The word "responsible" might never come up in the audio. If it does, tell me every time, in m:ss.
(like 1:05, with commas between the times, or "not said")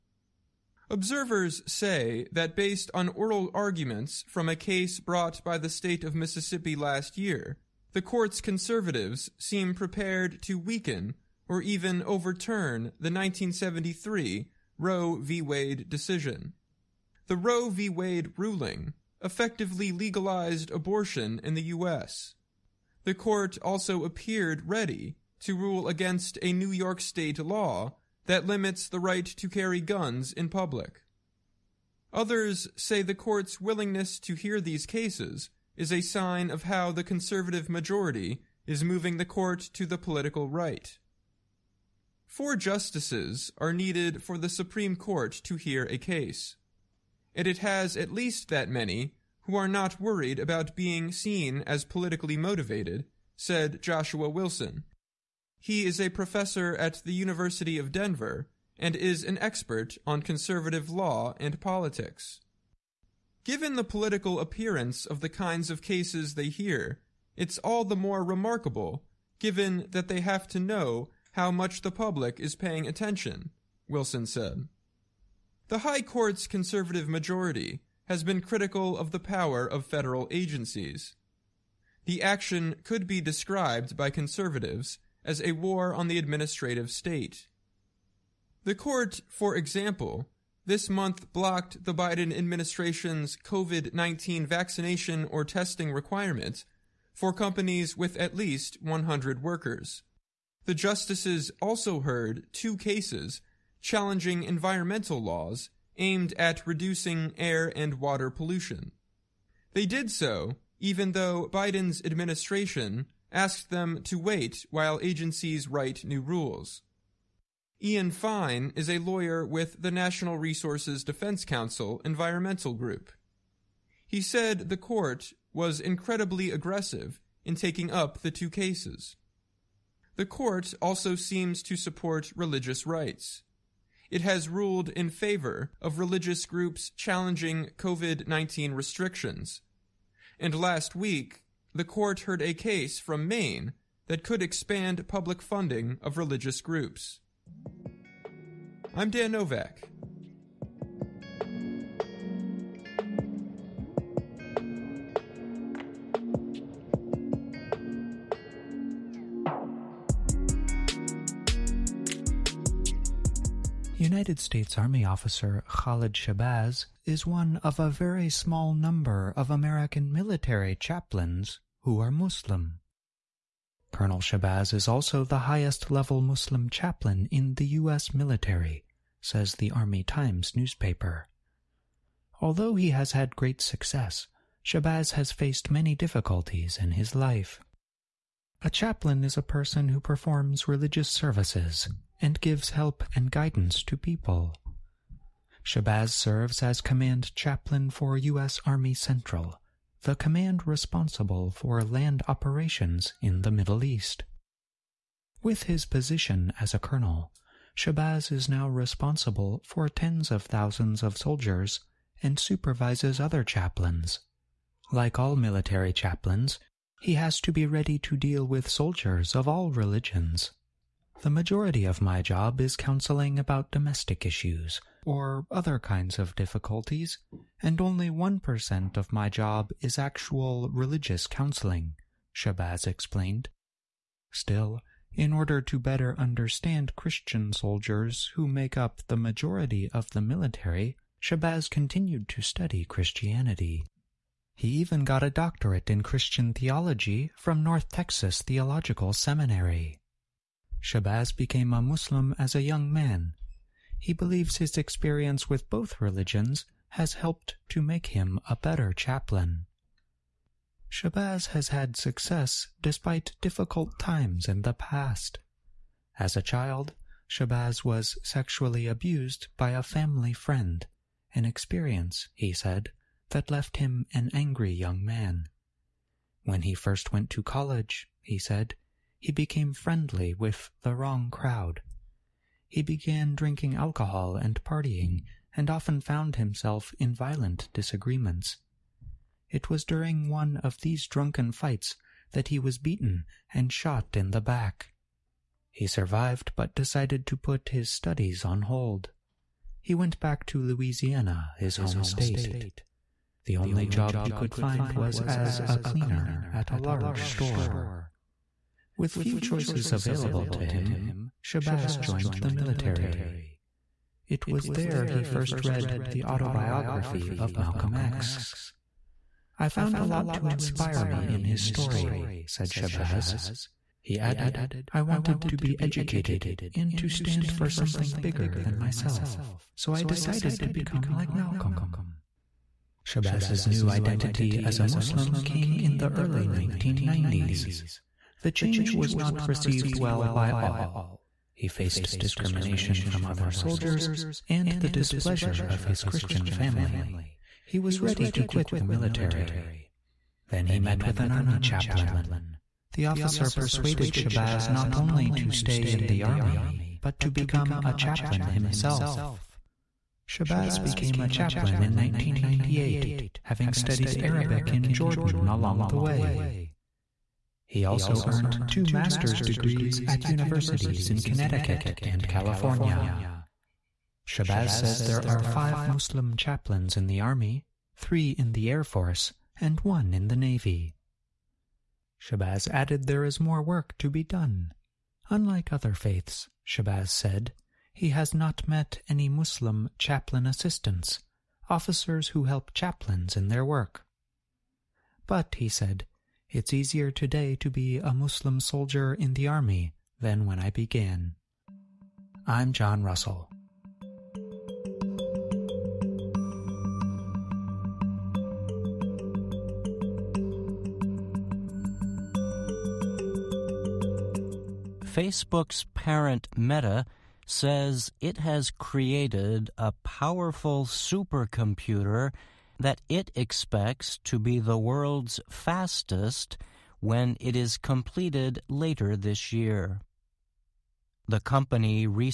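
3:20, 3:28.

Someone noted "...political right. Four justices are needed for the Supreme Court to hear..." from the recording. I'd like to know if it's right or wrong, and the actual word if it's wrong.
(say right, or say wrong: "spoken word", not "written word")
right.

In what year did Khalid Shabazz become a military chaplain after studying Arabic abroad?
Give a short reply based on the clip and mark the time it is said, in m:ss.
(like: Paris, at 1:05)
1998, at 6:01.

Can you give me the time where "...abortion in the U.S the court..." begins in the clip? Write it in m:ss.
0:20.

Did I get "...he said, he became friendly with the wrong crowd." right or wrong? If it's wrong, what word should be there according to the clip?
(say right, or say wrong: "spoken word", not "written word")
right.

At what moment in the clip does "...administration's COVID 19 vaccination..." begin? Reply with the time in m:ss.
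1:32.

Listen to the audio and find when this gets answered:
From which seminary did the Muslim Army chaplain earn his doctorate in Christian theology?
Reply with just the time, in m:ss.
4:07.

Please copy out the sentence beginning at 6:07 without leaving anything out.
He also earned two master's degrees at universities in Connecticut and California.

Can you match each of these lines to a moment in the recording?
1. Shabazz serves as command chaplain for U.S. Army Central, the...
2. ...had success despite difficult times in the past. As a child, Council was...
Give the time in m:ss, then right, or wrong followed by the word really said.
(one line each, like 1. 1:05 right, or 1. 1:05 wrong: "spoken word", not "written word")
1. 3:15 right
2. 4:21 wrong: "Shabazz", not "Council".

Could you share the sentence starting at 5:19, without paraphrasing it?
I found a lot to inspire me in his story, said Shabazz.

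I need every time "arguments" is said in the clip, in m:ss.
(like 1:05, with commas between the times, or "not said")
0:03.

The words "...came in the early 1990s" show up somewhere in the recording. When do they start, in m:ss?
5:35.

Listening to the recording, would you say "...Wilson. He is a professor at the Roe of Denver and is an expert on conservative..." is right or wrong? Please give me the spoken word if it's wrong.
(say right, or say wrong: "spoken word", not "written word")
wrong: "University", not "Roe".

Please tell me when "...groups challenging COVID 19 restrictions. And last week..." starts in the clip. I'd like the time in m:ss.
2:16.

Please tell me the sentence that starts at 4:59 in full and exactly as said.
He went back to Louisiana, his home state.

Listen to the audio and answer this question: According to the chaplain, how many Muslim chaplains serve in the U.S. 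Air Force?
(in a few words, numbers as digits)
3.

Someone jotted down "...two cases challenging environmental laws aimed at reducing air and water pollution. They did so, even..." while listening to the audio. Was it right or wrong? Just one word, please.
right.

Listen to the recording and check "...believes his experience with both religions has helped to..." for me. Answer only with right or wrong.
right.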